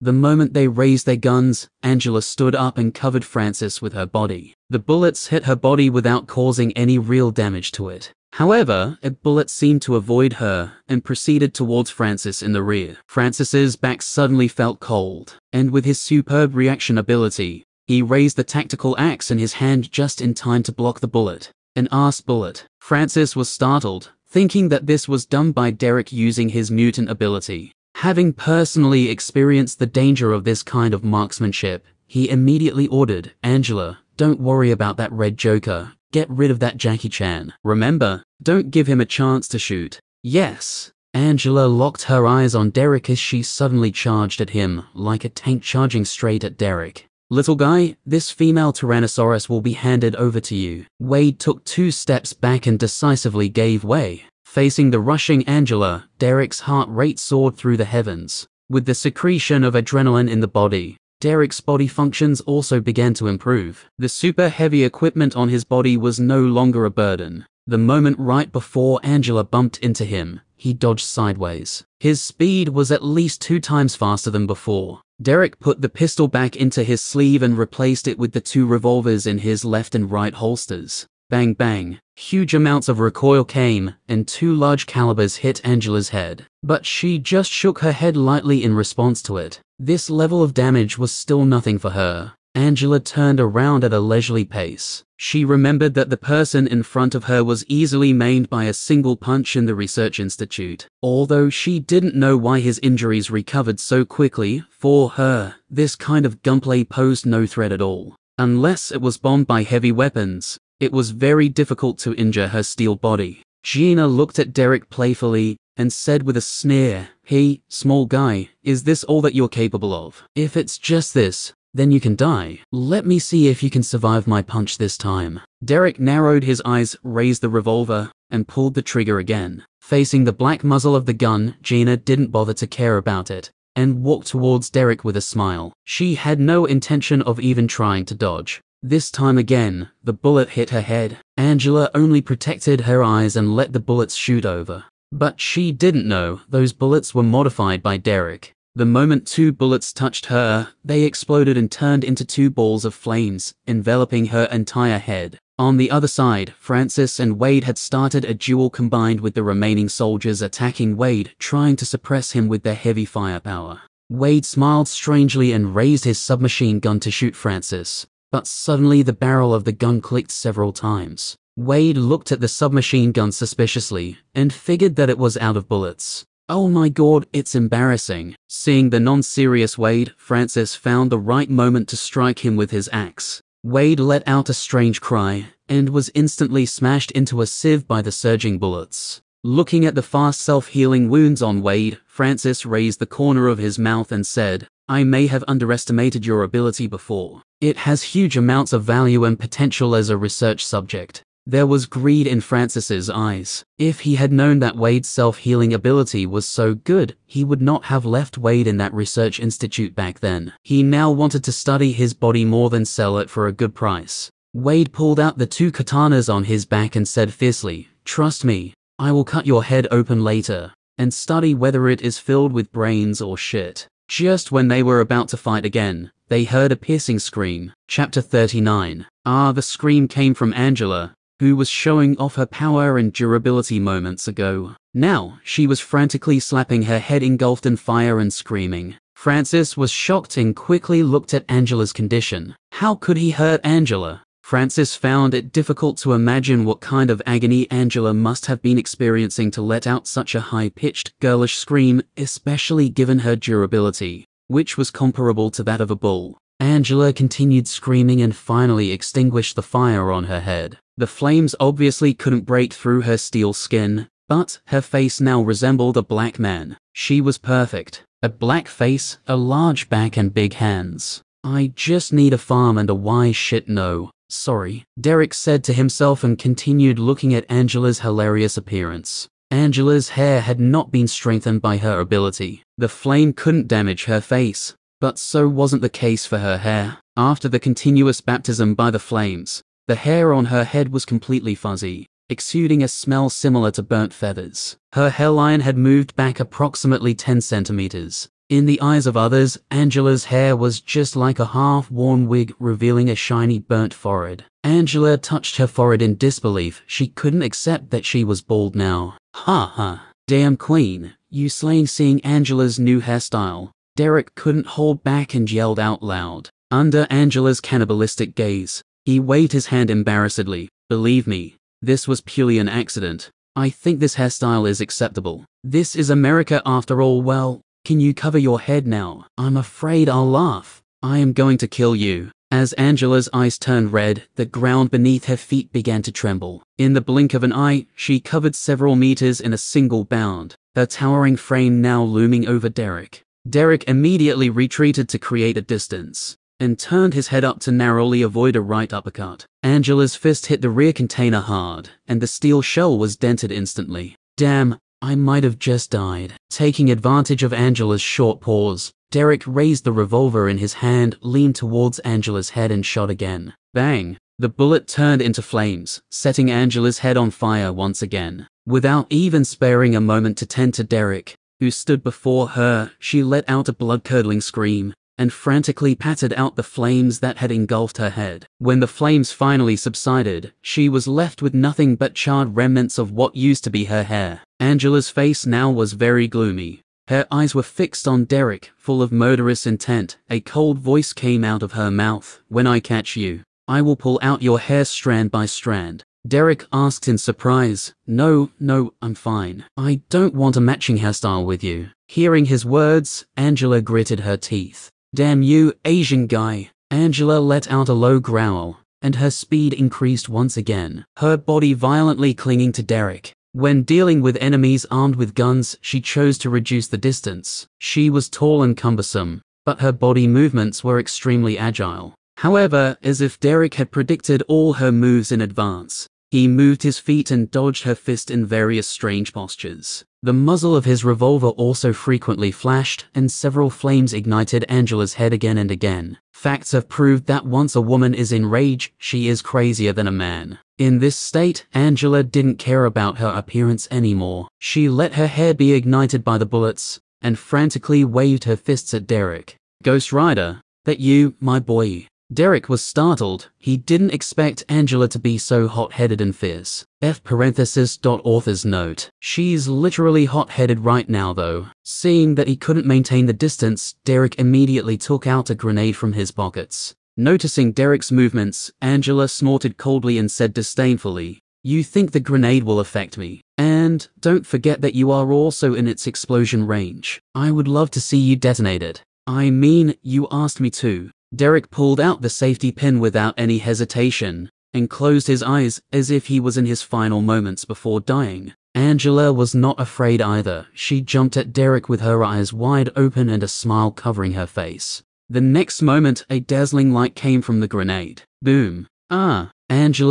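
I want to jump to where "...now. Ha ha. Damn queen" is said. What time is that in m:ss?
5:08.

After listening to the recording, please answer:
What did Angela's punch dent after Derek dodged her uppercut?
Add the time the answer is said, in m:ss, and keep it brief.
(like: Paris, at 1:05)
container, at 5:50.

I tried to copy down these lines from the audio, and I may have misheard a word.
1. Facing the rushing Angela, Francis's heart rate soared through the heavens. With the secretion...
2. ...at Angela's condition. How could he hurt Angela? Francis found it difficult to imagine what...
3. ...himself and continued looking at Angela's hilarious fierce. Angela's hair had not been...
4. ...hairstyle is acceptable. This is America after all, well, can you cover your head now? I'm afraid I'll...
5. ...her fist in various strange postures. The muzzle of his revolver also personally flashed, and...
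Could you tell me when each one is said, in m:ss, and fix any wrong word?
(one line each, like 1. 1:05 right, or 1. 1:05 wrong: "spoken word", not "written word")
1. 0:54 wrong: "Derek", not "Francis"
2. 4:01 right
3. 4:35 wrong: "appearance", not "fierce"
4. 5:24 right
5. 7:07 wrong: "frequently", not "personally".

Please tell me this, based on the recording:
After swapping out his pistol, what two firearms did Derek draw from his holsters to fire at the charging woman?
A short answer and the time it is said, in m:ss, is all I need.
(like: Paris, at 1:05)
revolvers, at 1:18.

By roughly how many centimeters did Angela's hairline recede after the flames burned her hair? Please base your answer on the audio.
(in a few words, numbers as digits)
10.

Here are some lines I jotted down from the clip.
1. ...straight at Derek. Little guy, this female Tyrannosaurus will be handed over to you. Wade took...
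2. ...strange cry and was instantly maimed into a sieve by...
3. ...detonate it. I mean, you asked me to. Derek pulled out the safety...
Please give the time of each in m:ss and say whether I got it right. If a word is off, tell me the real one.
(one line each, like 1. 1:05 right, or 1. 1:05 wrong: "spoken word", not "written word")
1. 0:46 right
2. 3:04 wrong: "smashed", not "maimed"
3. 7:58 right.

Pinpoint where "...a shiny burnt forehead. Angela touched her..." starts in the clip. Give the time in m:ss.
5:03.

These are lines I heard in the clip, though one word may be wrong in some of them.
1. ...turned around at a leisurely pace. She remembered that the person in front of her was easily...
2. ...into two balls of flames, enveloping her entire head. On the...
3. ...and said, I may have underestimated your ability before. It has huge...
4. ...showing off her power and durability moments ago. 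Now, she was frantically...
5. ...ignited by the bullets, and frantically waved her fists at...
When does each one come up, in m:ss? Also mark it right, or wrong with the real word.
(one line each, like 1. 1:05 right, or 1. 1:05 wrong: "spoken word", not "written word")
1. 1:32 right
2. 2:32 right
3. 3:14 right
4. 3:51 right
5. 7:25 right.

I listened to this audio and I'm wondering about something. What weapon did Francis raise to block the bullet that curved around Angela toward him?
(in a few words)
tactical axe.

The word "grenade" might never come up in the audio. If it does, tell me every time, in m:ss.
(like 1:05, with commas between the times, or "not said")
7:45, 7:52, 8:17.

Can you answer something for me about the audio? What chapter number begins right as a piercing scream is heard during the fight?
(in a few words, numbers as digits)
39.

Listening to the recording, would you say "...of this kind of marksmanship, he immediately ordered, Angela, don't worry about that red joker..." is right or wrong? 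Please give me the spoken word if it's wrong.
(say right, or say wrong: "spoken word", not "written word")
right.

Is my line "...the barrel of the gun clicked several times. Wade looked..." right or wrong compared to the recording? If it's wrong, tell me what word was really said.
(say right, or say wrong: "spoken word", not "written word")
right.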